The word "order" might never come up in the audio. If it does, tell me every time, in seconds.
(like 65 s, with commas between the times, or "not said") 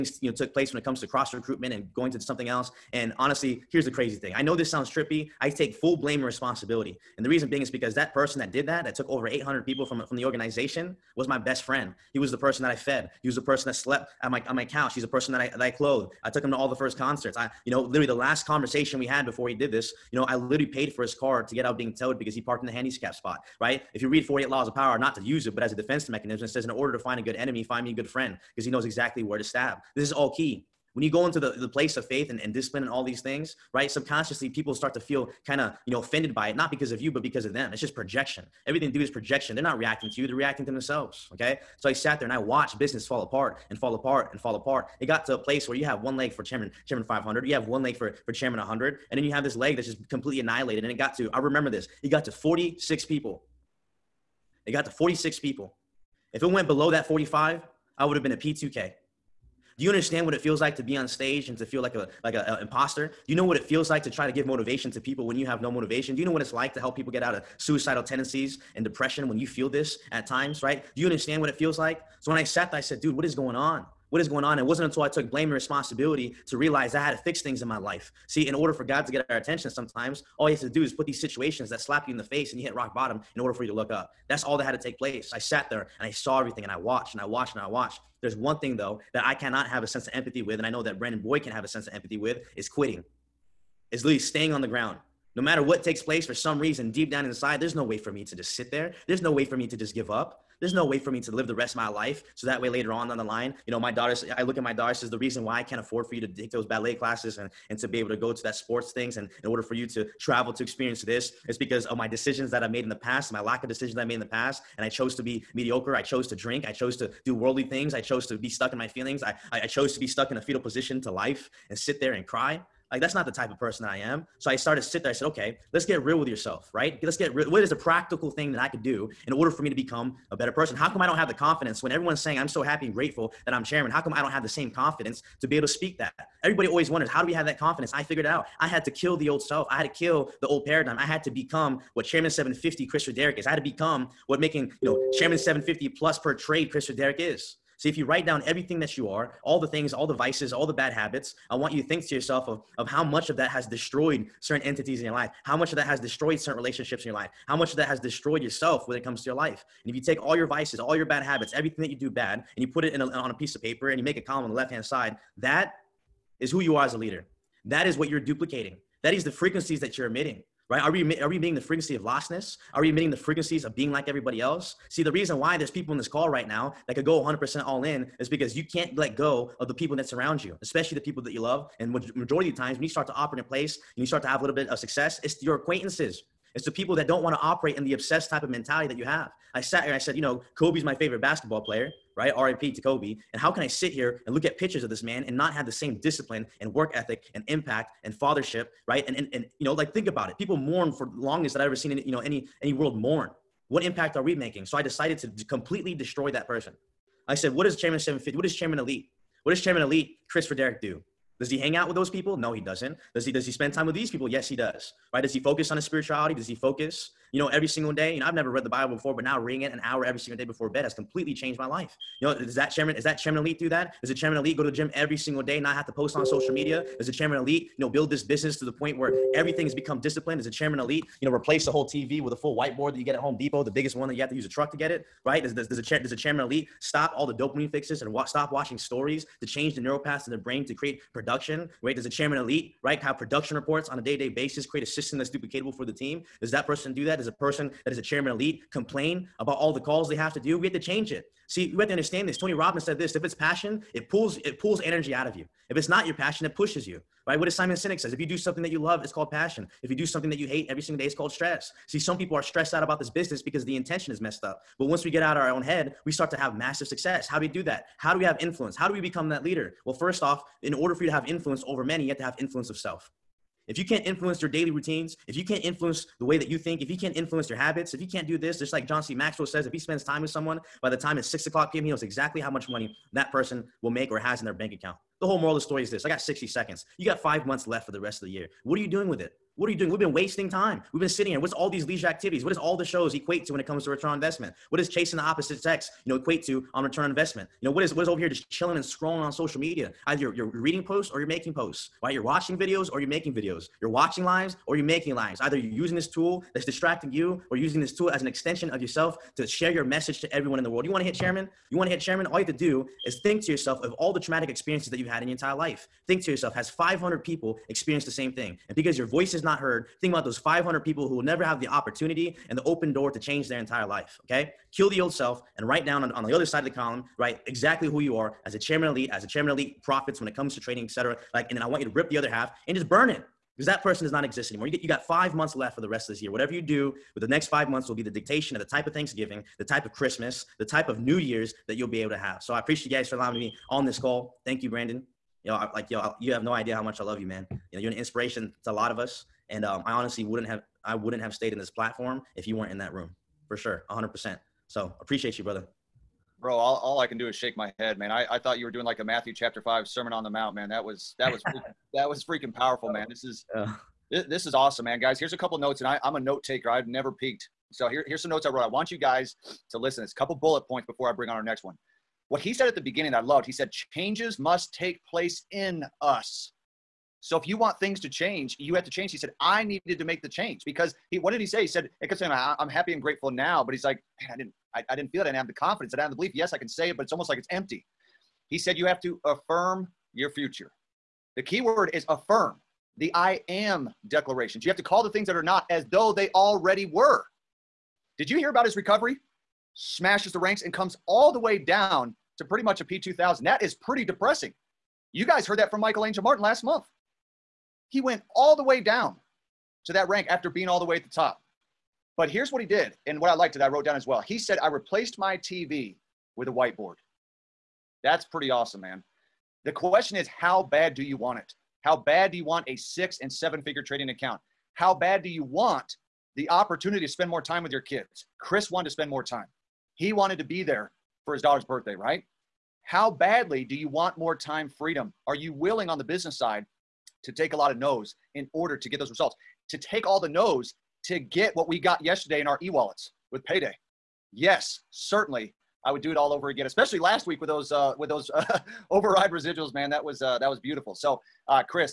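26 s, 78 s, 83 s, 109 s, 129 s, 270 s, 438 s.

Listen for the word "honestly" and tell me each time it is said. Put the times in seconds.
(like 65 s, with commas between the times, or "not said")
3 s, 349 s.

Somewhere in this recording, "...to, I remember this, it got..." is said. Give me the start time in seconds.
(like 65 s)
51 s.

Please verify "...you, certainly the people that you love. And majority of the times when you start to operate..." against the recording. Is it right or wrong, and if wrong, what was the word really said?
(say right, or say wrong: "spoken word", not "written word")
wrong: "especially", not "certainly".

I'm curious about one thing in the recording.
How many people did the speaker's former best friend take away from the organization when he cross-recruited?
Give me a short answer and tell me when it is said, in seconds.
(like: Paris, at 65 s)
800, at 9 s.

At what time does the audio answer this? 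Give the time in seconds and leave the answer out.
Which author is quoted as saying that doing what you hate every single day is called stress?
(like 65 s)
257 s.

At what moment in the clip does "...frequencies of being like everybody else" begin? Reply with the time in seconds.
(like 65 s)
173 s.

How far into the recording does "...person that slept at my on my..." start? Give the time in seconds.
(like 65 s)
13 s.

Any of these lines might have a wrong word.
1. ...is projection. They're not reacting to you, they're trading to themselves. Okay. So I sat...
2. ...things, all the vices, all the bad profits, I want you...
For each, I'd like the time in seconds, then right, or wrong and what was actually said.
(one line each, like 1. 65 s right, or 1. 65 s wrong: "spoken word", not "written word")
1. 39 s wrong: "reacting", not "trading"
2. 149 s wrong: "habits", not "profits".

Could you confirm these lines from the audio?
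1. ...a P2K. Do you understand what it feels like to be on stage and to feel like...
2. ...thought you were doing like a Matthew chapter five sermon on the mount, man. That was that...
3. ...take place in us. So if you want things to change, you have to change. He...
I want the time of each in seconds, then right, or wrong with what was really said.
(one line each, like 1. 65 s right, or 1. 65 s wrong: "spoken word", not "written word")
1. 58 s right
2. 358 s right
3. 374 s right.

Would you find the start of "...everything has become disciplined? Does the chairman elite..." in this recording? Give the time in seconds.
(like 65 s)
229 s.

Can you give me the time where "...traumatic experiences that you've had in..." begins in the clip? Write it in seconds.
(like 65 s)
314 s.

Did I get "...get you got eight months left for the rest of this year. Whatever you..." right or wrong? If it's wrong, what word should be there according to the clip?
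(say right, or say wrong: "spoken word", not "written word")
wrong: "five", not "eight".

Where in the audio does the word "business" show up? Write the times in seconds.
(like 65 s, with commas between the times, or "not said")
42 s, 228 s, 263 s, 436 s.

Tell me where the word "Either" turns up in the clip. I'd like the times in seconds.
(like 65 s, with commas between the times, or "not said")
300 s, 305 s.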